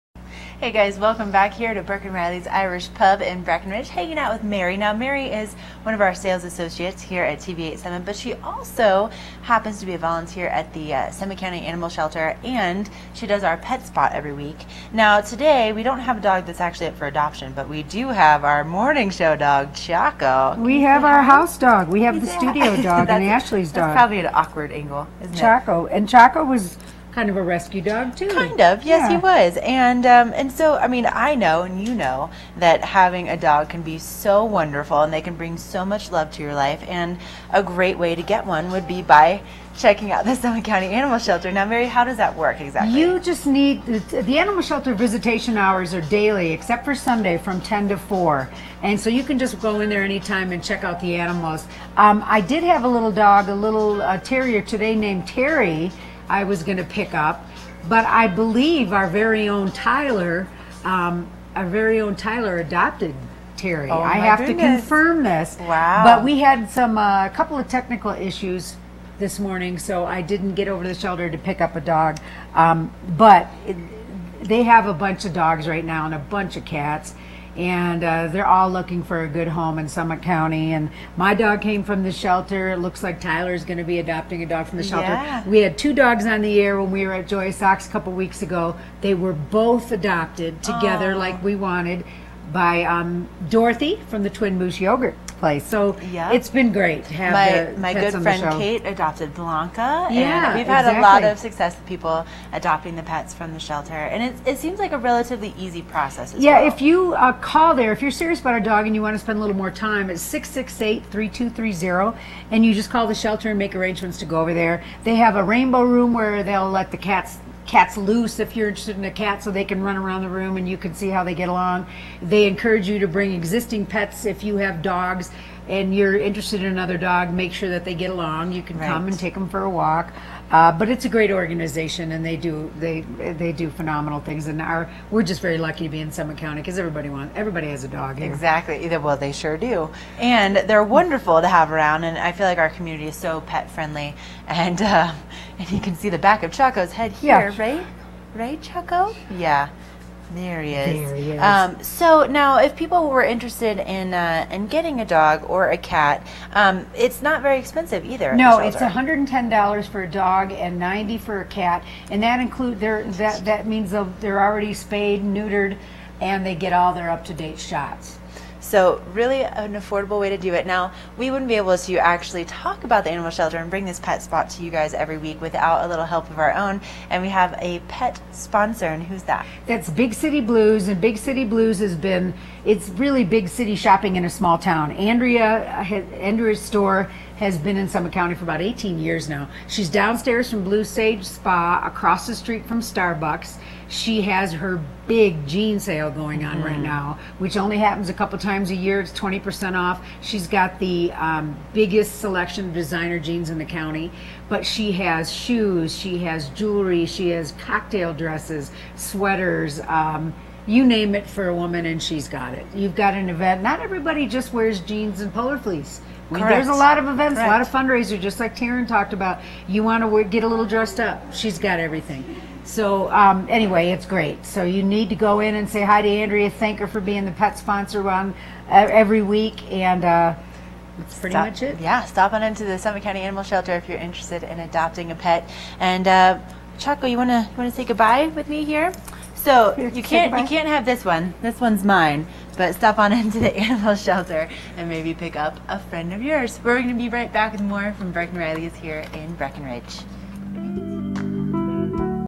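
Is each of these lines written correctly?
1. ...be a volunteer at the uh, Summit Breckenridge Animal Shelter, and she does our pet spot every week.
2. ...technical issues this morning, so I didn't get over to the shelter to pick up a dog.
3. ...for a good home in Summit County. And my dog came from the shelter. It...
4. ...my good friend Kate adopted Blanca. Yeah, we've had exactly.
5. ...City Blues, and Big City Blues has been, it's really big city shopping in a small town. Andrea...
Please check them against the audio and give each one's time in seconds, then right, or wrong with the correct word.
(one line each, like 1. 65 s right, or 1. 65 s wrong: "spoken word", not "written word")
1. 9 s wrong: "County", not "Breckenridge"
2. 67 s right
3. 79 s right
4. 97 s right
5. 180 s right.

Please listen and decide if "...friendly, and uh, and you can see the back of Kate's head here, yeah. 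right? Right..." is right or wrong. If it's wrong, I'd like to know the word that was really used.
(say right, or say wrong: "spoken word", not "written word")
wrong: "Chaco", not "Kate".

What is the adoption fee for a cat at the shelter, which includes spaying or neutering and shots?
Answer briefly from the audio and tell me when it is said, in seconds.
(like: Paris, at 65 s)
$90, at 160 s.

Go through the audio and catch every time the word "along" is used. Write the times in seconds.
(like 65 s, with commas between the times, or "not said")
121 s, 128 s.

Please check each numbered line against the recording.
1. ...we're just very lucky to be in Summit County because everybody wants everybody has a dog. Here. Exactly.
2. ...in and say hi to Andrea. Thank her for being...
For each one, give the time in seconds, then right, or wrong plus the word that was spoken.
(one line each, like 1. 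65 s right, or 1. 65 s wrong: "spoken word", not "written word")
1. 135 s right
2. 225 s right.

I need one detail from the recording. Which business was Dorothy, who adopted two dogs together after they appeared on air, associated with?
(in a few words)
Twin Moose Yogurt.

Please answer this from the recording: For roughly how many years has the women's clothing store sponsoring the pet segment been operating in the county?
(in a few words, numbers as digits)
18.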